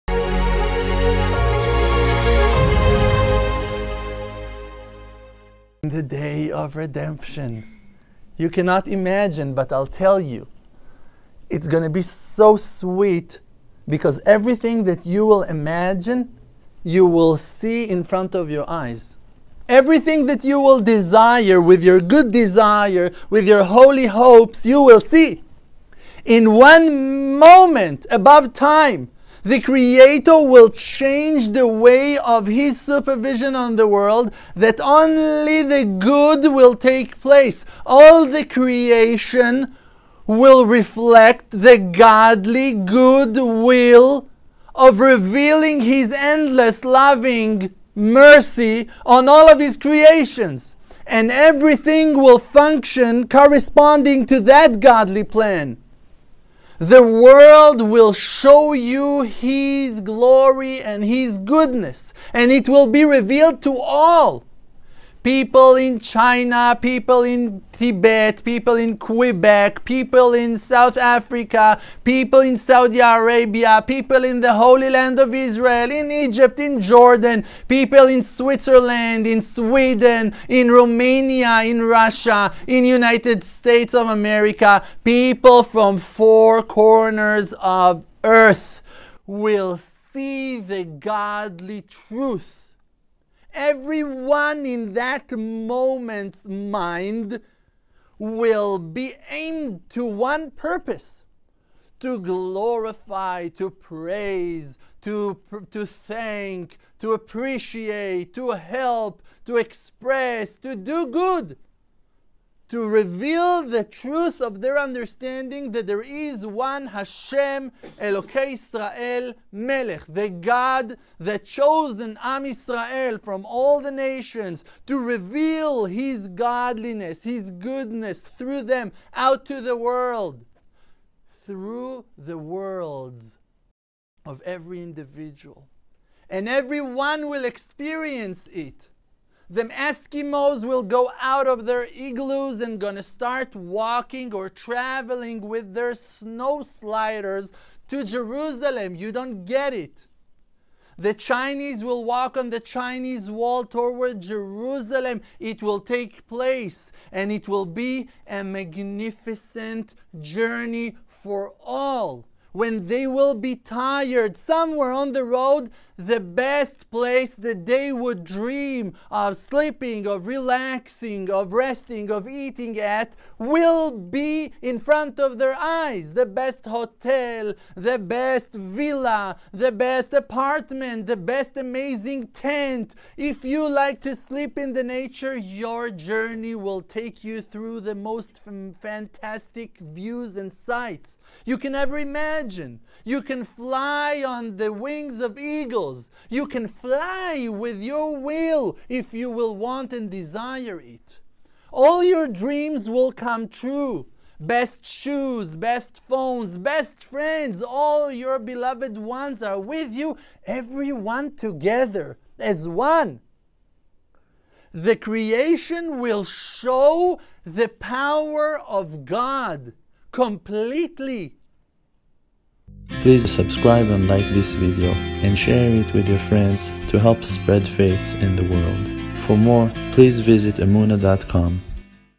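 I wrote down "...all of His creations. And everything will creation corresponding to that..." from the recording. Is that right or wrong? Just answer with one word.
wrong.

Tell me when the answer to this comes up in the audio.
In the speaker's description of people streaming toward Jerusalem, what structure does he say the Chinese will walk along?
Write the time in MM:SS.
02:32.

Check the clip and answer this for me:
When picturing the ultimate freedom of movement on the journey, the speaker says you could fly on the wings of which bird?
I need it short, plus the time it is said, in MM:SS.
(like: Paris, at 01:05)
Eagles, at 03:15.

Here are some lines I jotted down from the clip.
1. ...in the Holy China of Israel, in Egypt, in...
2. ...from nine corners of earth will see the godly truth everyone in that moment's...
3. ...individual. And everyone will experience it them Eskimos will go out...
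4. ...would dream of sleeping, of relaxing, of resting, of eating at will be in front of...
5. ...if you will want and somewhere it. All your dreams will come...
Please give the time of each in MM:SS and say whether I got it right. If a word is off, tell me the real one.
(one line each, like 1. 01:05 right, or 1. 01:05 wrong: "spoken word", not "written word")
1. 01:14 wrong: "Land", not "China"
2. 01:25 wrong: "four", not "nine"
3. 02:14 right
4. 02:47 right
5. 03:18 wrong: "desire", not "somewhere".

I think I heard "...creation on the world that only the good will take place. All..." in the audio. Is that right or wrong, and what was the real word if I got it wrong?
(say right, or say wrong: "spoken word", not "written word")
wrong: "supervision", not "creation".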